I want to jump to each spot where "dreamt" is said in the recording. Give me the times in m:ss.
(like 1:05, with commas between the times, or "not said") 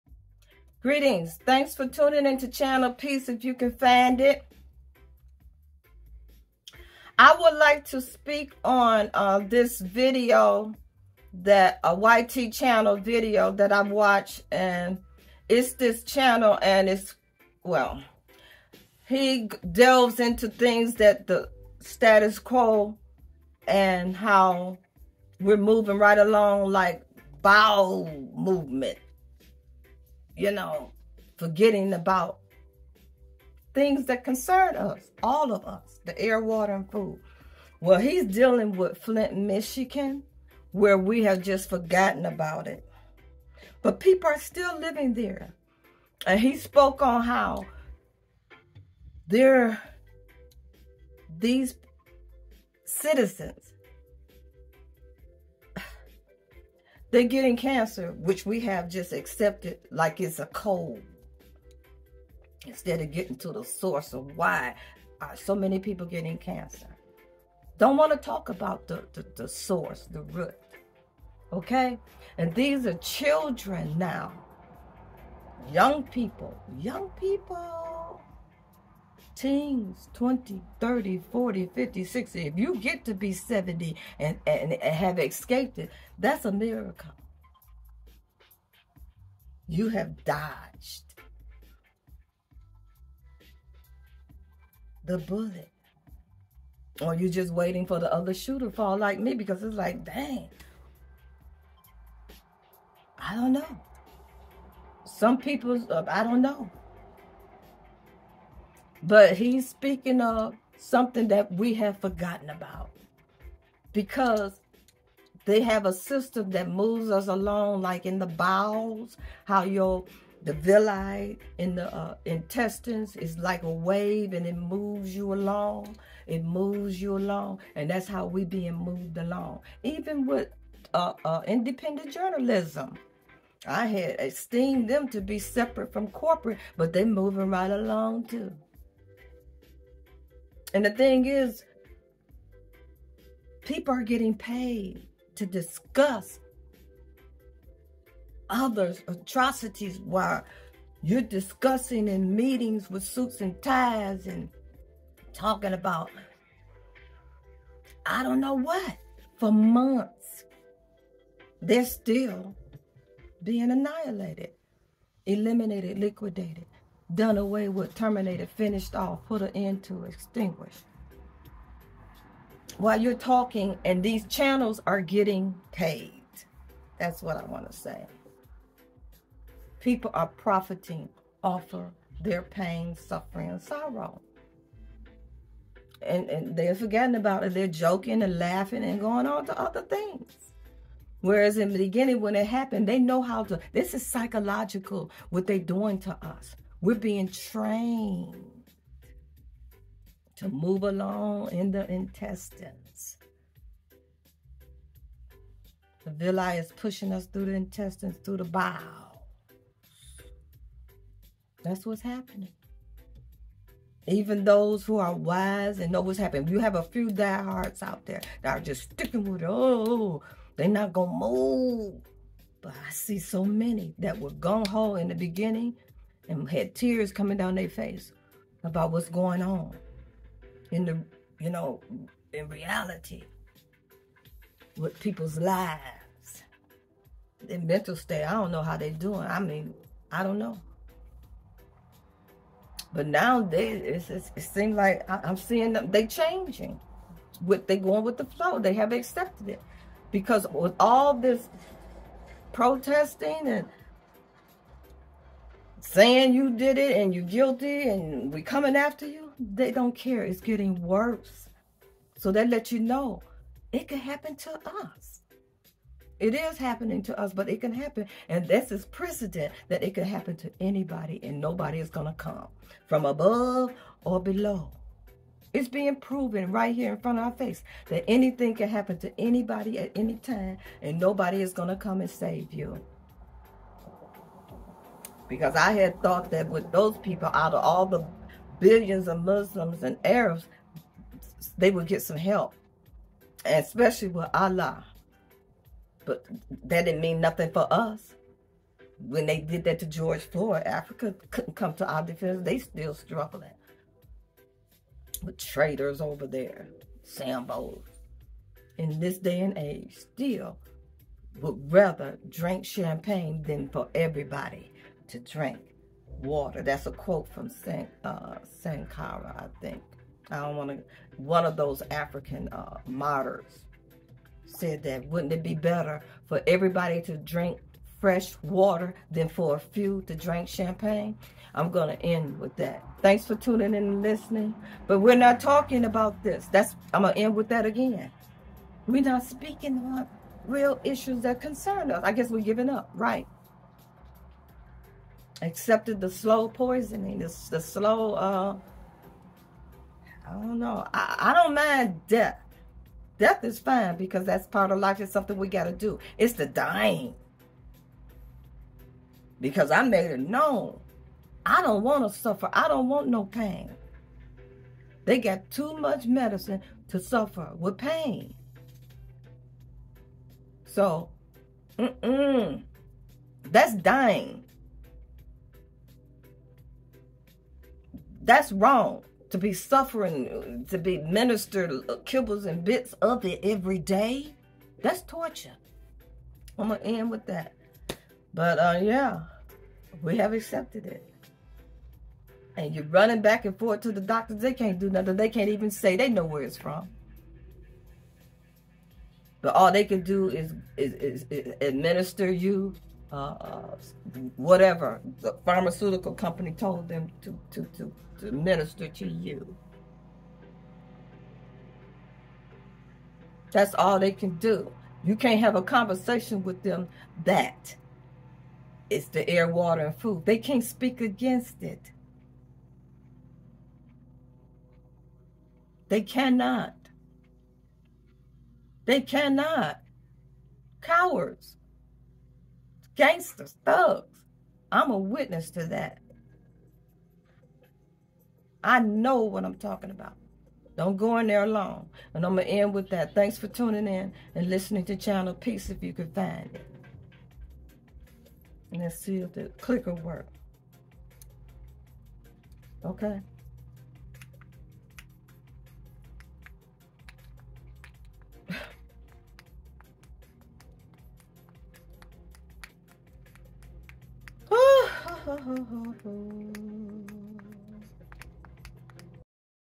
not said.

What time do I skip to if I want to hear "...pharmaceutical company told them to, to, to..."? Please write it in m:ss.
6:45.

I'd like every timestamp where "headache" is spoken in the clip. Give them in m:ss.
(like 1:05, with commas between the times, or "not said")
not said.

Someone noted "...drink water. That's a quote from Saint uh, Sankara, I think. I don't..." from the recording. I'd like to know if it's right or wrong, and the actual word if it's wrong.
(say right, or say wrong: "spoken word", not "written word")
right.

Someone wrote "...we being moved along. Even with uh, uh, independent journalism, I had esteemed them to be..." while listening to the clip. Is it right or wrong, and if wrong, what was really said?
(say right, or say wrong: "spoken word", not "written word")
right.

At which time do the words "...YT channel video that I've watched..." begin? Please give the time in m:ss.
0:11.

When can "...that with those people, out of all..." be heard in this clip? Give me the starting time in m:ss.
4:46.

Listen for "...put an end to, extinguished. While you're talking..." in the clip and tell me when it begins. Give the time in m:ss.
2:49.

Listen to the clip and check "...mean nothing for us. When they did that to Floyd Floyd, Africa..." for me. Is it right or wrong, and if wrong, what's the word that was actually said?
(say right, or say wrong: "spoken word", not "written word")
wrong: "George", not "Floyd".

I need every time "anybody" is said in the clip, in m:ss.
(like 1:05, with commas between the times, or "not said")
4:30, 4:39.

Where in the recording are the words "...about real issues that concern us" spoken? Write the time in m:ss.
5:39.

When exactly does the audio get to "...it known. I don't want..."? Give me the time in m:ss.
6:00.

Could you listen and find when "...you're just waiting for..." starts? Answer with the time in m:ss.
1:37.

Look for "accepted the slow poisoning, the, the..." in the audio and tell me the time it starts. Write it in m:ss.
5:45.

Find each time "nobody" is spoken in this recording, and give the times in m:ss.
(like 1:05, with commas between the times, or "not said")
4:31, 4:40.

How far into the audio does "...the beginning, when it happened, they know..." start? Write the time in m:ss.
3:11.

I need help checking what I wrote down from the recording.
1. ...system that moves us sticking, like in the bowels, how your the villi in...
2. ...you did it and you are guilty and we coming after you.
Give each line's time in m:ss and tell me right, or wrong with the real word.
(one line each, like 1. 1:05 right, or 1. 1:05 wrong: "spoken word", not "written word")
1. 1:55 wrong: "along", not "sticking"
2. 4:16 right.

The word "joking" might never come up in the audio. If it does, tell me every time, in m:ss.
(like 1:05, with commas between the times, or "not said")
3:07.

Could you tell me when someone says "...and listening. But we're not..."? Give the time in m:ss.
5:33.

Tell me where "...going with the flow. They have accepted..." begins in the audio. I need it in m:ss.
4:07.